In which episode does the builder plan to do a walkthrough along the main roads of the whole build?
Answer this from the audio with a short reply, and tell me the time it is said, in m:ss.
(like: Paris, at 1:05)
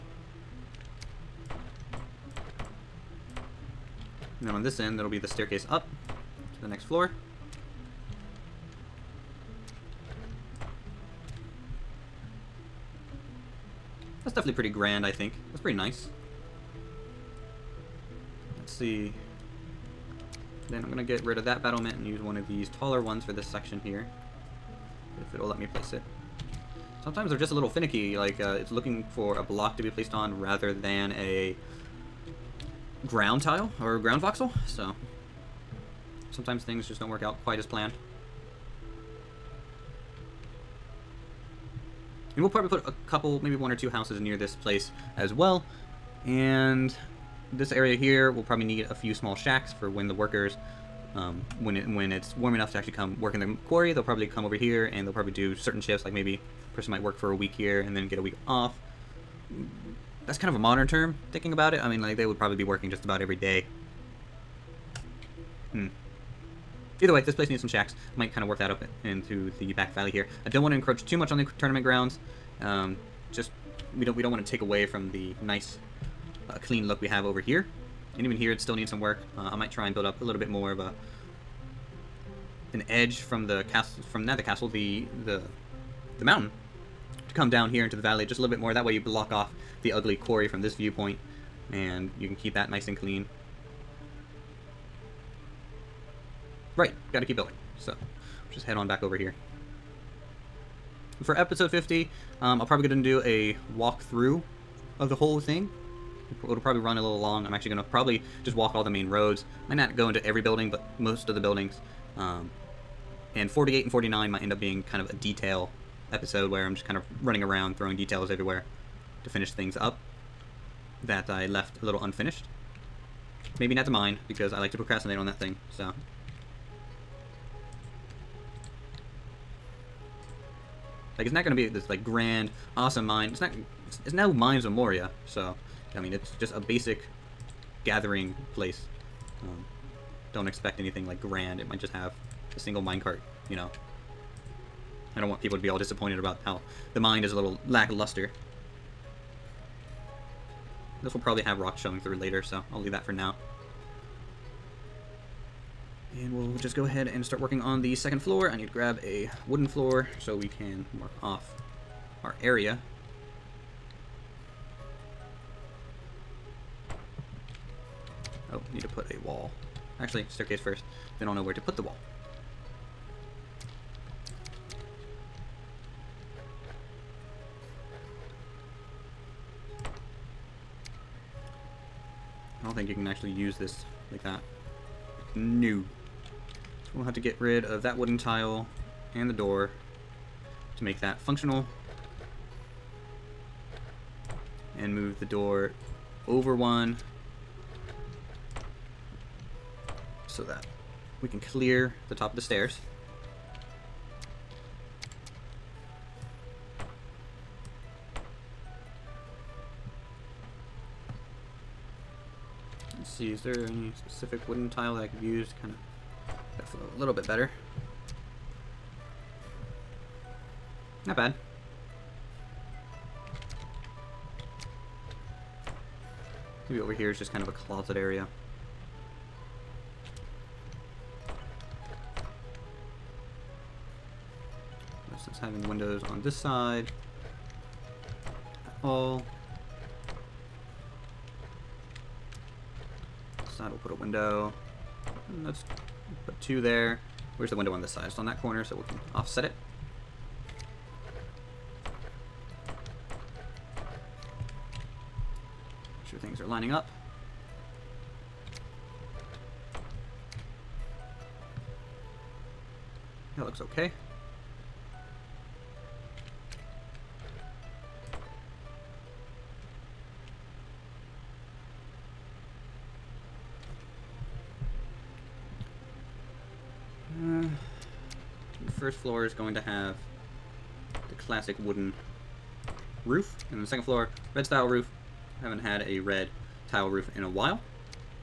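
50, at 1:41.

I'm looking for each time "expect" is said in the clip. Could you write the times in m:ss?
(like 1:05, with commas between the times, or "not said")
2:20.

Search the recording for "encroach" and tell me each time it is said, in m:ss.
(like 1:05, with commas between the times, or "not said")
1:10.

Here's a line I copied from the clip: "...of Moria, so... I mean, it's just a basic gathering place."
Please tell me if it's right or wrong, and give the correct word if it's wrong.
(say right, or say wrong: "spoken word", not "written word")
right.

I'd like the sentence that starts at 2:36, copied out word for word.
And we'll just go ahead and start working on the second floor.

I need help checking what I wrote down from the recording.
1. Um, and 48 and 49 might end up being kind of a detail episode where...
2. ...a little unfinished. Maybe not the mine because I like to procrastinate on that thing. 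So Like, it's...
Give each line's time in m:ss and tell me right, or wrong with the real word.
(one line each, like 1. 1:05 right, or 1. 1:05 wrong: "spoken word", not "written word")
1. 1:52 right
2. 2:01 right.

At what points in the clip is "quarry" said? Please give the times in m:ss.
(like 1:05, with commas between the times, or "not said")
0:53, 1:30.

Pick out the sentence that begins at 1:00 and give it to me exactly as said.
That's kind of a modern term, thinking about it.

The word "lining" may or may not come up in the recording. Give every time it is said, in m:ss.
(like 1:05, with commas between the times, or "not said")
4:16.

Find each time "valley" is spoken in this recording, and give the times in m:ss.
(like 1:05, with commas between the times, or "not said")
1:09, 1:28.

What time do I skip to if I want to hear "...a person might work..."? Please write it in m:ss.
0:56.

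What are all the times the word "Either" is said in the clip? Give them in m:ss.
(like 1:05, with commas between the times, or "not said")
1:06.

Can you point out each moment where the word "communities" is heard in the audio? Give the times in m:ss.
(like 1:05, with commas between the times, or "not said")
not said.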